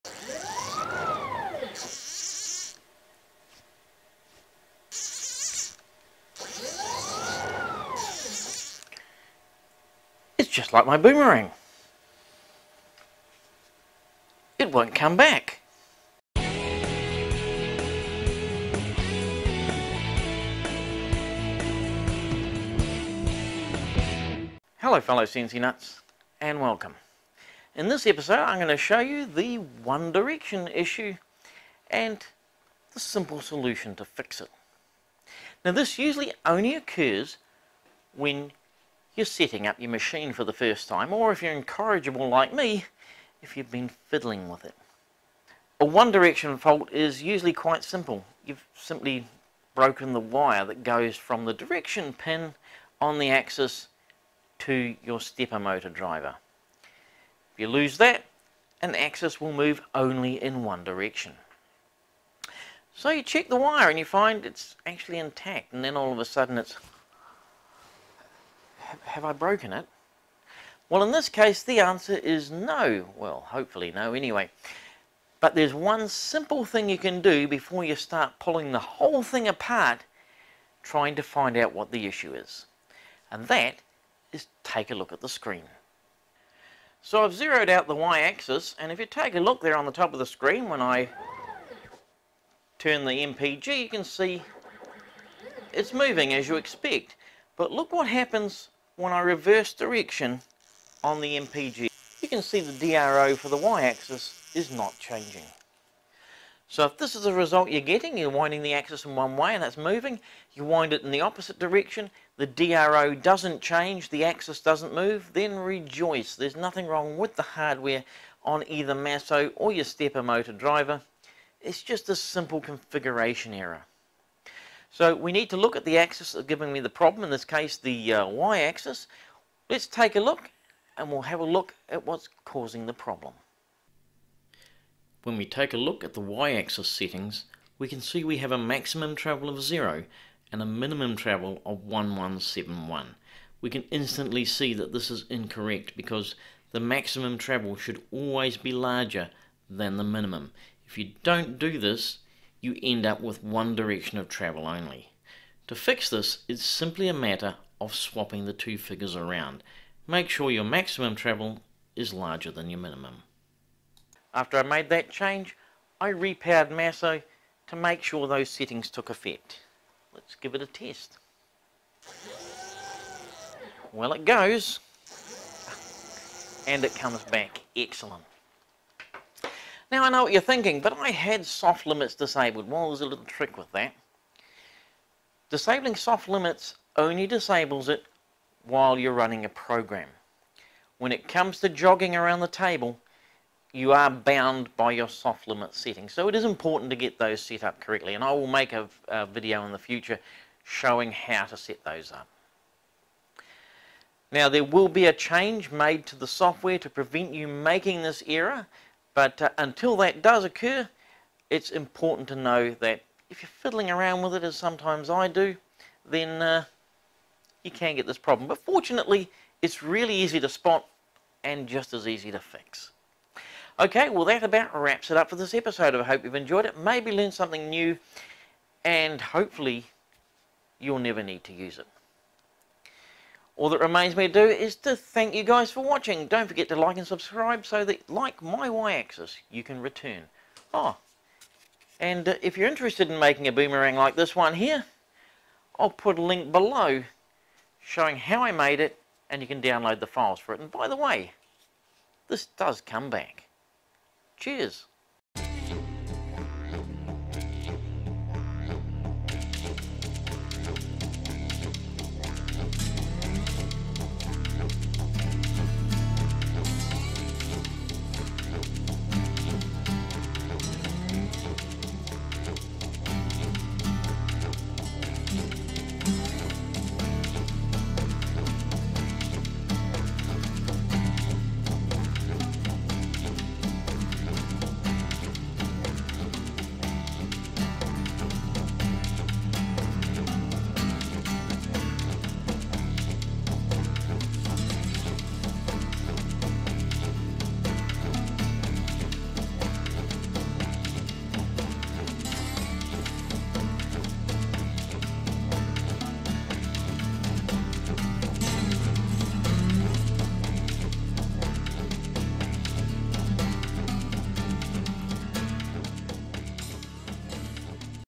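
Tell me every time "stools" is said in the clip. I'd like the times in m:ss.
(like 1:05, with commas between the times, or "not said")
not said.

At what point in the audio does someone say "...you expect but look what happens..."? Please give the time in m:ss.
1:36.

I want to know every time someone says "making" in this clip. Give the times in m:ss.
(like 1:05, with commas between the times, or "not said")
3:27, 4:03.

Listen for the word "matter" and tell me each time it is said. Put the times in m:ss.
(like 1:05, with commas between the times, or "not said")
2:37.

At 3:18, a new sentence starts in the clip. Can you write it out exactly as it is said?
And I will make a, a video in the future showing how to set those up.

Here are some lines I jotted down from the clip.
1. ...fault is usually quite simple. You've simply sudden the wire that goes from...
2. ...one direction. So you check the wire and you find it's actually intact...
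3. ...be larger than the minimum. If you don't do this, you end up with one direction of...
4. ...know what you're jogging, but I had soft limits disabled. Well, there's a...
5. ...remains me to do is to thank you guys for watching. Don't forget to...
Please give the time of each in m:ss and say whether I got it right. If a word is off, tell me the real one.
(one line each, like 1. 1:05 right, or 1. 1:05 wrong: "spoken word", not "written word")
1. 0:46 wrong: "broken", not "sudden"
2. 1:00 right
3. 2:28 right
4. 3:00 wrong: "thinking", not "jogging"
5. 3:53 right.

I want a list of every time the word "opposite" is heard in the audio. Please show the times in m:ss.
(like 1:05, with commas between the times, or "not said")
1:51.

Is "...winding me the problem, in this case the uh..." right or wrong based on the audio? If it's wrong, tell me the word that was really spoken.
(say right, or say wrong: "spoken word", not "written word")
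wrong: "giving", not "winding".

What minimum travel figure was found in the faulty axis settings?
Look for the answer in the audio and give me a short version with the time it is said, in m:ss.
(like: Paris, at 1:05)
1171, at 2:21.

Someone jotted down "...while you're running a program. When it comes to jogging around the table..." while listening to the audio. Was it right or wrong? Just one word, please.
right.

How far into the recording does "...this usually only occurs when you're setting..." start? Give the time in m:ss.
0:35.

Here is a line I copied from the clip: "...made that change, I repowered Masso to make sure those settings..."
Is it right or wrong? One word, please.
right.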